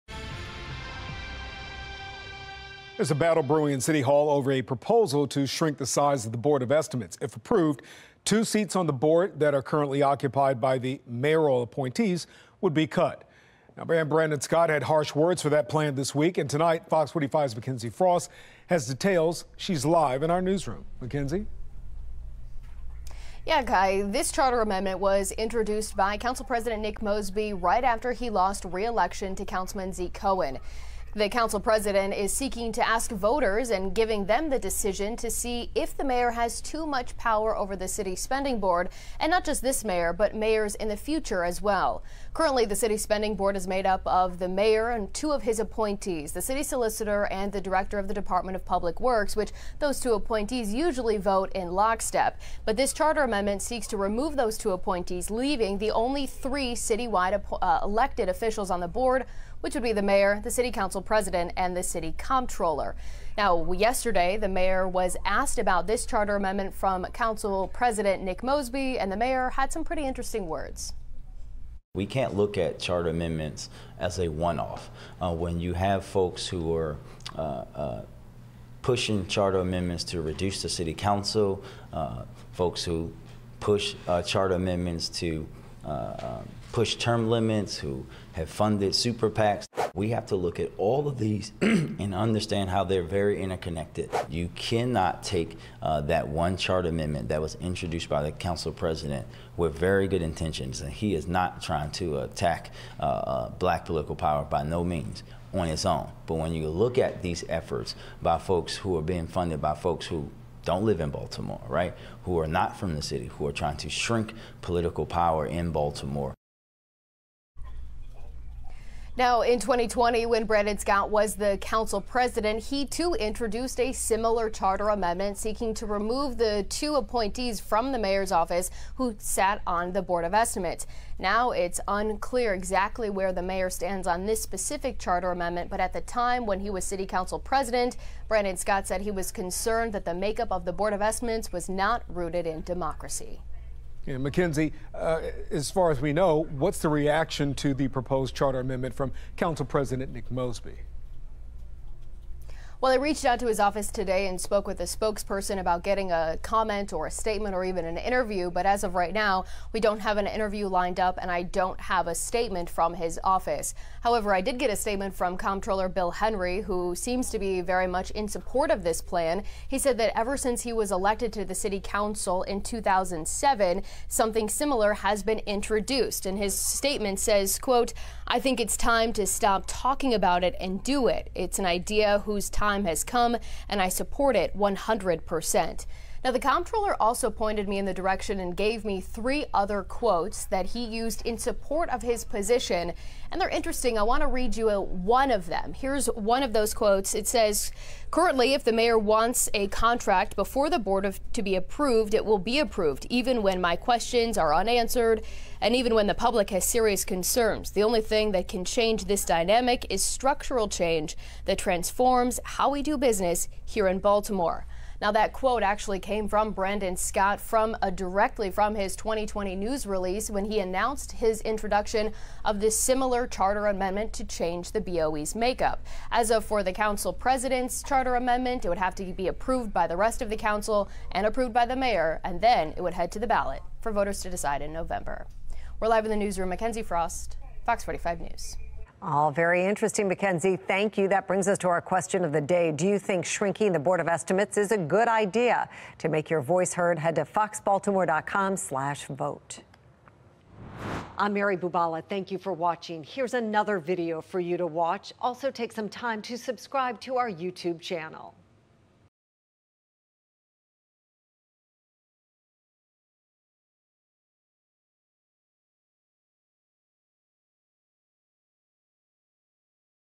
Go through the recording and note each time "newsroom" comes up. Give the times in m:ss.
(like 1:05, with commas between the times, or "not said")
0:20, 3:56.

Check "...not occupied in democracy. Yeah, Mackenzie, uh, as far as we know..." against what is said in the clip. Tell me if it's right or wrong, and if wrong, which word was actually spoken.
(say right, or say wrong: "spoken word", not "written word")
wrong: "rooted", not "occupied".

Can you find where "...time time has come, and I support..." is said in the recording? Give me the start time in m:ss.
3:02.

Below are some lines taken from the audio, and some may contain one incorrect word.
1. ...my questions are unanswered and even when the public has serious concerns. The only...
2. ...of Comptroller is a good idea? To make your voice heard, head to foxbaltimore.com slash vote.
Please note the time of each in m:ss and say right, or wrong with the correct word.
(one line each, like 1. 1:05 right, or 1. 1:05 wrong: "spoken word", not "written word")
1. 3:23 right
2. 4:03 wrong: "Estimates", not "Comptroller".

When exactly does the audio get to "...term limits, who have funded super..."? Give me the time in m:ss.
1:26.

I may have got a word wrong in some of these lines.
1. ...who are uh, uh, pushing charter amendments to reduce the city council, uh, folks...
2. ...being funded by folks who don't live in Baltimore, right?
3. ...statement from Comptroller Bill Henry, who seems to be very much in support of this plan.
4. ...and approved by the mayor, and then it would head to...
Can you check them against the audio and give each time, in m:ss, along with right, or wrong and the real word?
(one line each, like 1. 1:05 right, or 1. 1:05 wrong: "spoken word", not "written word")
1. 1:16 right
2. 1:49 right
3. 2:44 right
4. 3:51 right.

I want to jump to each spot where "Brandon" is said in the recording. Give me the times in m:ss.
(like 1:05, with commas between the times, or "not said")
0:14, 2:00, 2:18, 3:36.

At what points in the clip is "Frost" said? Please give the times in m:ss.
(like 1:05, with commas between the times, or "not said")
0:17, 3:56.